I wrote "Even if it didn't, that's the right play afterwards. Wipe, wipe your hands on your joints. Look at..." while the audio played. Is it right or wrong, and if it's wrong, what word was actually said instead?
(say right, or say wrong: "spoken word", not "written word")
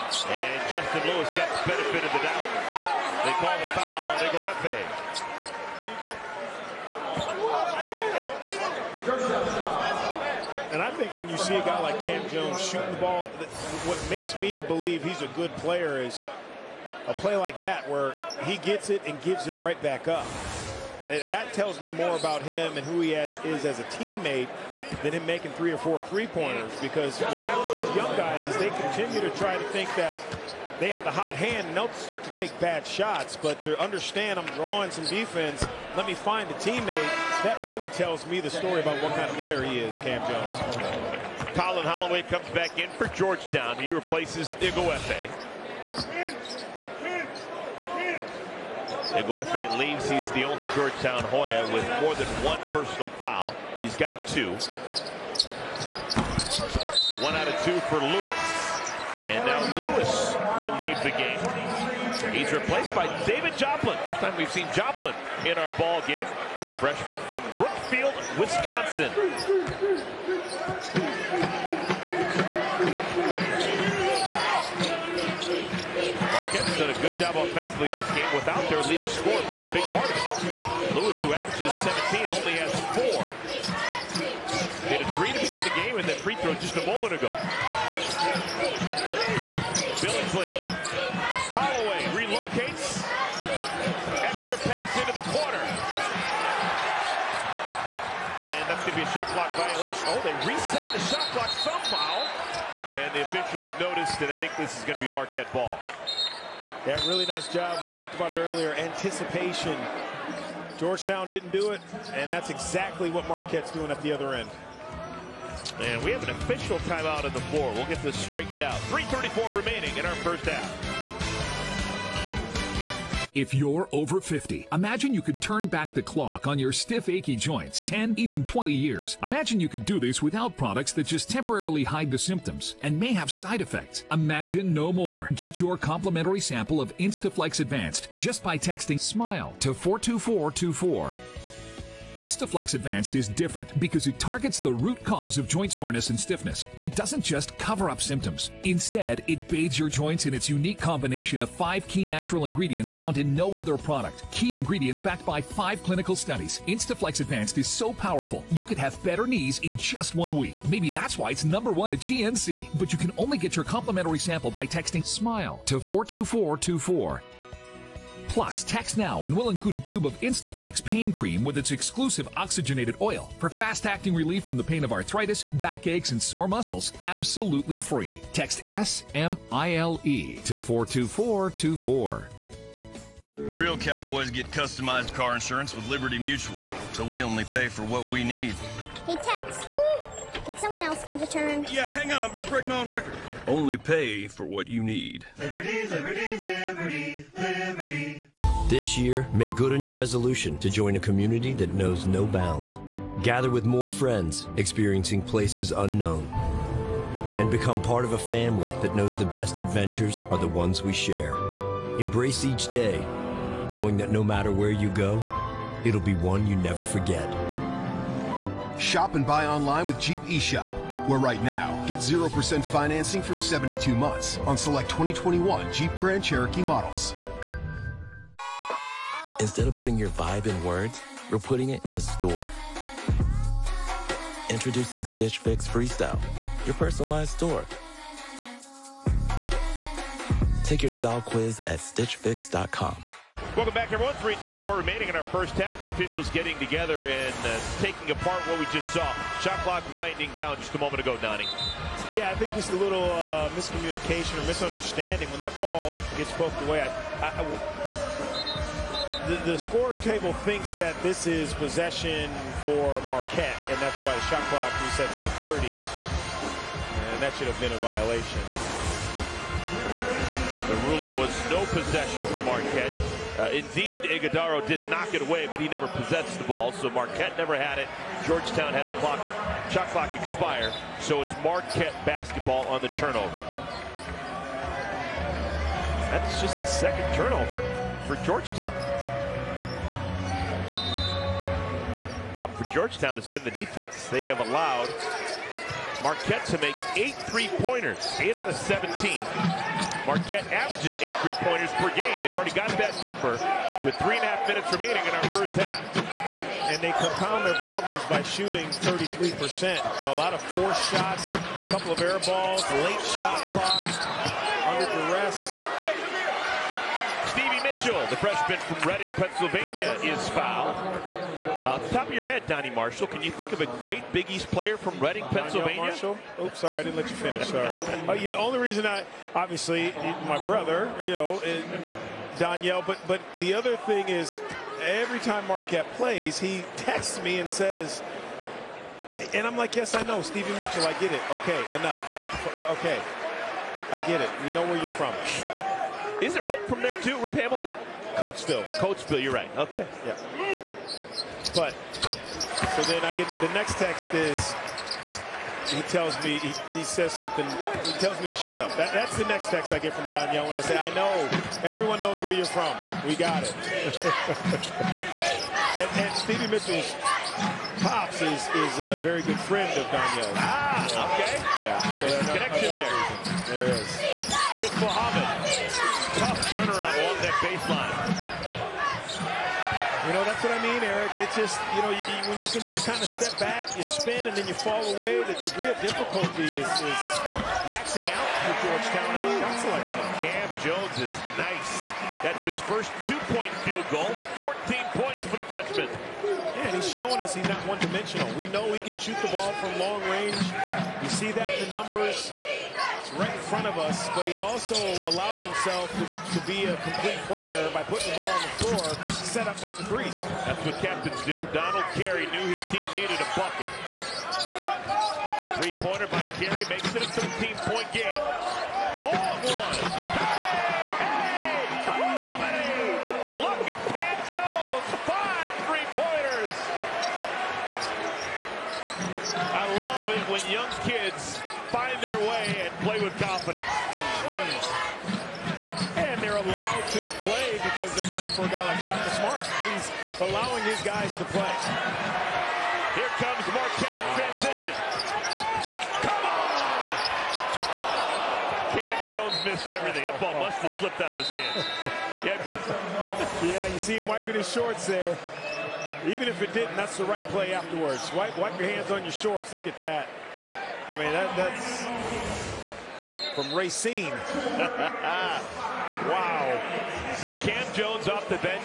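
wrong: "shorts", not "joints".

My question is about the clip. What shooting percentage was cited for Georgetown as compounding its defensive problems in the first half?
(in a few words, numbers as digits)
33%.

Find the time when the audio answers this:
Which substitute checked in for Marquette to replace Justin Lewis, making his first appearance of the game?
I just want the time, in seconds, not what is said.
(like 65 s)
63 s.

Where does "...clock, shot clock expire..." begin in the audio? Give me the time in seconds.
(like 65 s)
278 s.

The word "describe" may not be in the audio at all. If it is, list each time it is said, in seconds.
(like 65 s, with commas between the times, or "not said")
not said.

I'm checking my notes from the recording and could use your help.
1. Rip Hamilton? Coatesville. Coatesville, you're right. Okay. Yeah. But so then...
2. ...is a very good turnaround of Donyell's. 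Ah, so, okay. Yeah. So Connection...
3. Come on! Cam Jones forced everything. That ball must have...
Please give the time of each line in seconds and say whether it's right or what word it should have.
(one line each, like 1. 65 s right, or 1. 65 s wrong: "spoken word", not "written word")
1. 347 s right
2. 368 s wrong: "friend", not "turnaround"
3. 446 s wrong: "missed", not "forced".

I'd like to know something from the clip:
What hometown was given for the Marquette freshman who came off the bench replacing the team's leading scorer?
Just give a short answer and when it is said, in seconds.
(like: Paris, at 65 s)
Brookfield, Wisconsin, at 67 s.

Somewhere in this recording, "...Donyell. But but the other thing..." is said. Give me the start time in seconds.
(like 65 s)
332 s.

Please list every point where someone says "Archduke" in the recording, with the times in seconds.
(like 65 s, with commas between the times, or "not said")
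not said.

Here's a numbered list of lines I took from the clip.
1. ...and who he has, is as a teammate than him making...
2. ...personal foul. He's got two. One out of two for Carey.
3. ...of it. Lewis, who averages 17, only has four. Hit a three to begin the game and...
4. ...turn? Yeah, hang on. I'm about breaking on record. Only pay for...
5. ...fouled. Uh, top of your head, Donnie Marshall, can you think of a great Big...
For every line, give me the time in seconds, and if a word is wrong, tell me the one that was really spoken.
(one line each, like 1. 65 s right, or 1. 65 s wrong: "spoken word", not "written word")
1. 22 s right
2. 52 s wrong: "Lewis", not "Carey"
3. 80 s right
4. 191 s right
5. 320 s right.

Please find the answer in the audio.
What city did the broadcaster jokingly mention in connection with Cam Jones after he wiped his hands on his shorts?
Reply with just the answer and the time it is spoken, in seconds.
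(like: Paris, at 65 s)
Racine, at 463 s.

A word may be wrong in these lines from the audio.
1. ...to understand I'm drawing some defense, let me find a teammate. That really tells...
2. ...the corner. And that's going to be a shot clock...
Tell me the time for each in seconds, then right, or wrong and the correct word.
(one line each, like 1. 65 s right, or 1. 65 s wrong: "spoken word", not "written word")
1. 33 s right
2. 95 s right.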